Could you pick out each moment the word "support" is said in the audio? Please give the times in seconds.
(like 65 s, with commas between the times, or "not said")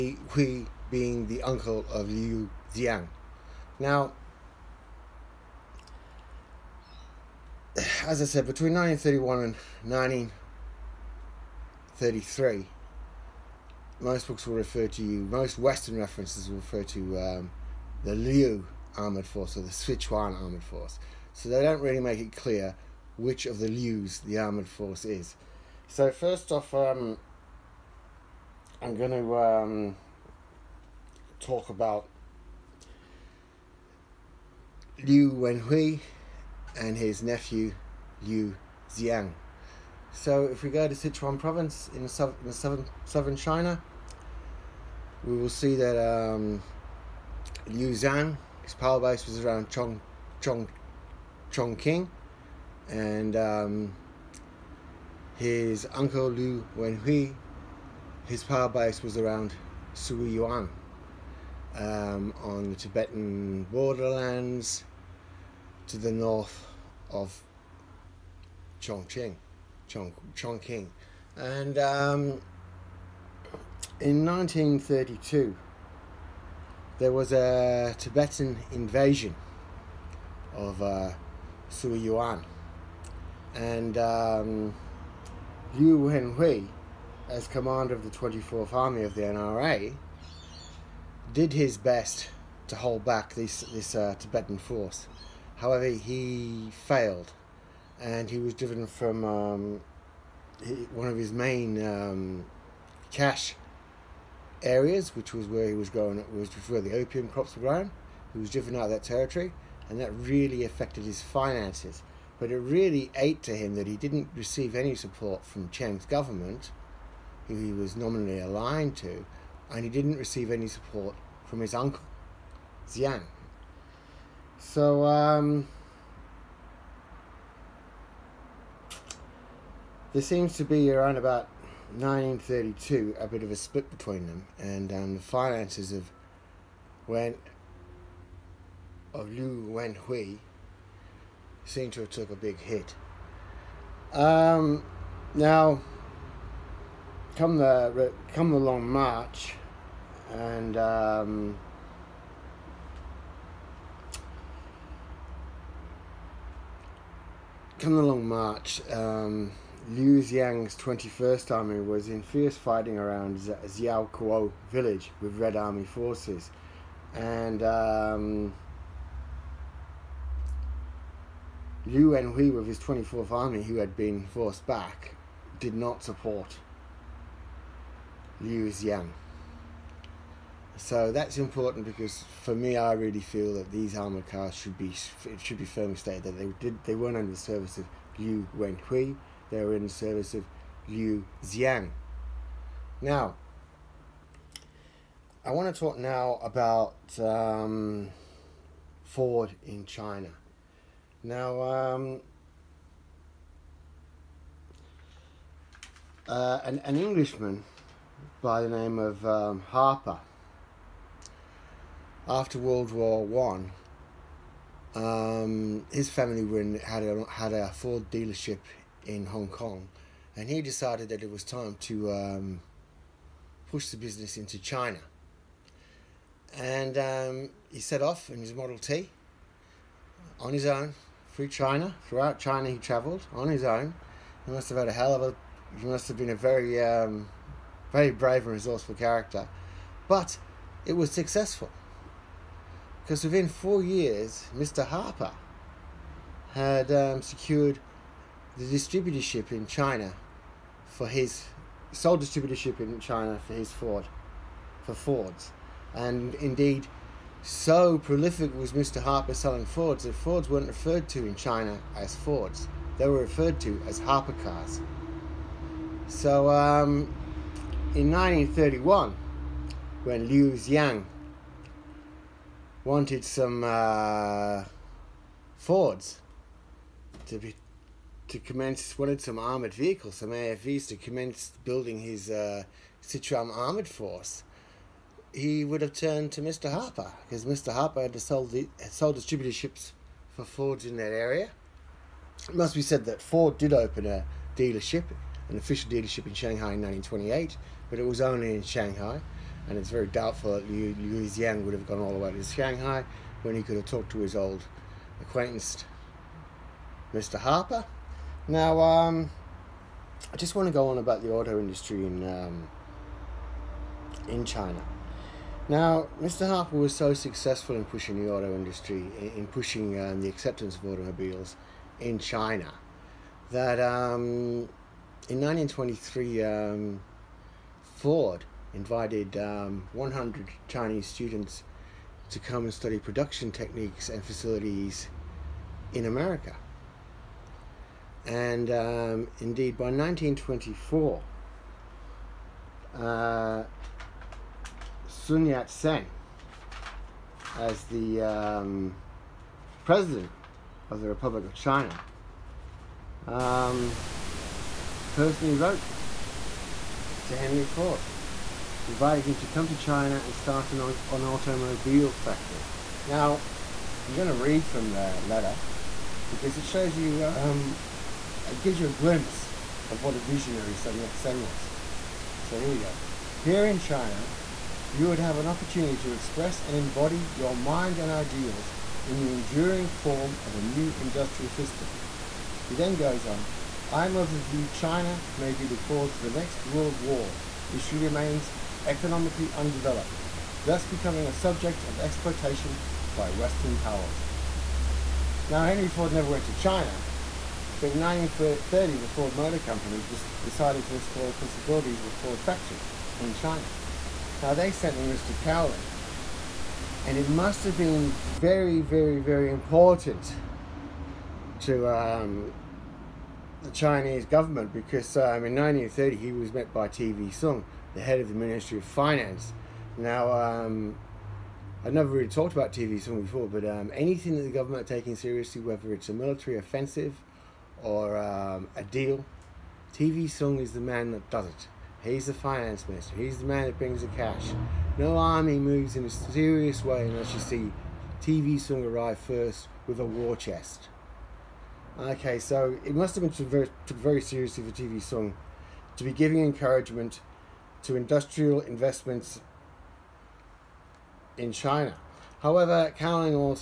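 114 s, 120 s, 176 s.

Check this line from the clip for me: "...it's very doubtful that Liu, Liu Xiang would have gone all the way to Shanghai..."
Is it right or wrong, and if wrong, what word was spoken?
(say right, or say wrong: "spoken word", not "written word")
right.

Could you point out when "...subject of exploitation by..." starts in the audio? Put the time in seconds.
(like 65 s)
391 s.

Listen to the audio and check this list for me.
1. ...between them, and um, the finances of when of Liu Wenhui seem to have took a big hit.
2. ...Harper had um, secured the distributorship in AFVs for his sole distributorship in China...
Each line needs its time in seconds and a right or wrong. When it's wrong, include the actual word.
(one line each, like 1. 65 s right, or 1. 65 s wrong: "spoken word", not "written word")
1. 133 s right
2. 244 s wrong: "China", not "AFVs".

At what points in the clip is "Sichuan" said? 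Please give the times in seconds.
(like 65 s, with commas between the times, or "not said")
19 s, 40 s.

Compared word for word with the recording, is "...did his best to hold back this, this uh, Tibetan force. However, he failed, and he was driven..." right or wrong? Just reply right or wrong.
right.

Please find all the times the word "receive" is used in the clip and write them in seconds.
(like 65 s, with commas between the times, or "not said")
114 s, 120 s.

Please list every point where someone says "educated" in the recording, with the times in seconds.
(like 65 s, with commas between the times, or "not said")
not said.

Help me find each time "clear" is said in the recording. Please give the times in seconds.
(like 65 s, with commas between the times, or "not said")
22 s.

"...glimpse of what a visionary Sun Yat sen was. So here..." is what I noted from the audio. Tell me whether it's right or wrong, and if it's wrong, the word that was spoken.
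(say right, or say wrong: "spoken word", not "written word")
right.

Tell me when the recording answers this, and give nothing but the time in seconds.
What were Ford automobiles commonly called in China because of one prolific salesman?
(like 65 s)
264 s.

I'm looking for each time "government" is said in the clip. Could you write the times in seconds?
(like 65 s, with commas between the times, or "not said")
116 s, 414 s, 424 s.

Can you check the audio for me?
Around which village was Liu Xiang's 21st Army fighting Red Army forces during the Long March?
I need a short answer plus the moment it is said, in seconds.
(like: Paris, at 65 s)
Xiao Kuo, at 163 s.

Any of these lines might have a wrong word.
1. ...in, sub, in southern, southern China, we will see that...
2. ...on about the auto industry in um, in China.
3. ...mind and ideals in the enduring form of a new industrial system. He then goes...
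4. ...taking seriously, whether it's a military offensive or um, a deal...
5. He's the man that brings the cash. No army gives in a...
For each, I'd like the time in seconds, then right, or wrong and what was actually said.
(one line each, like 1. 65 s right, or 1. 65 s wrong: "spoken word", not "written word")
1. 41 s right
2. 310 s right
3. 377 s right
4. 424 s right
5. 433 s wrong: "moves", not "gives".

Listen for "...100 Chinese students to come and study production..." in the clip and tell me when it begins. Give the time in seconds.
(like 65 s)
329 s.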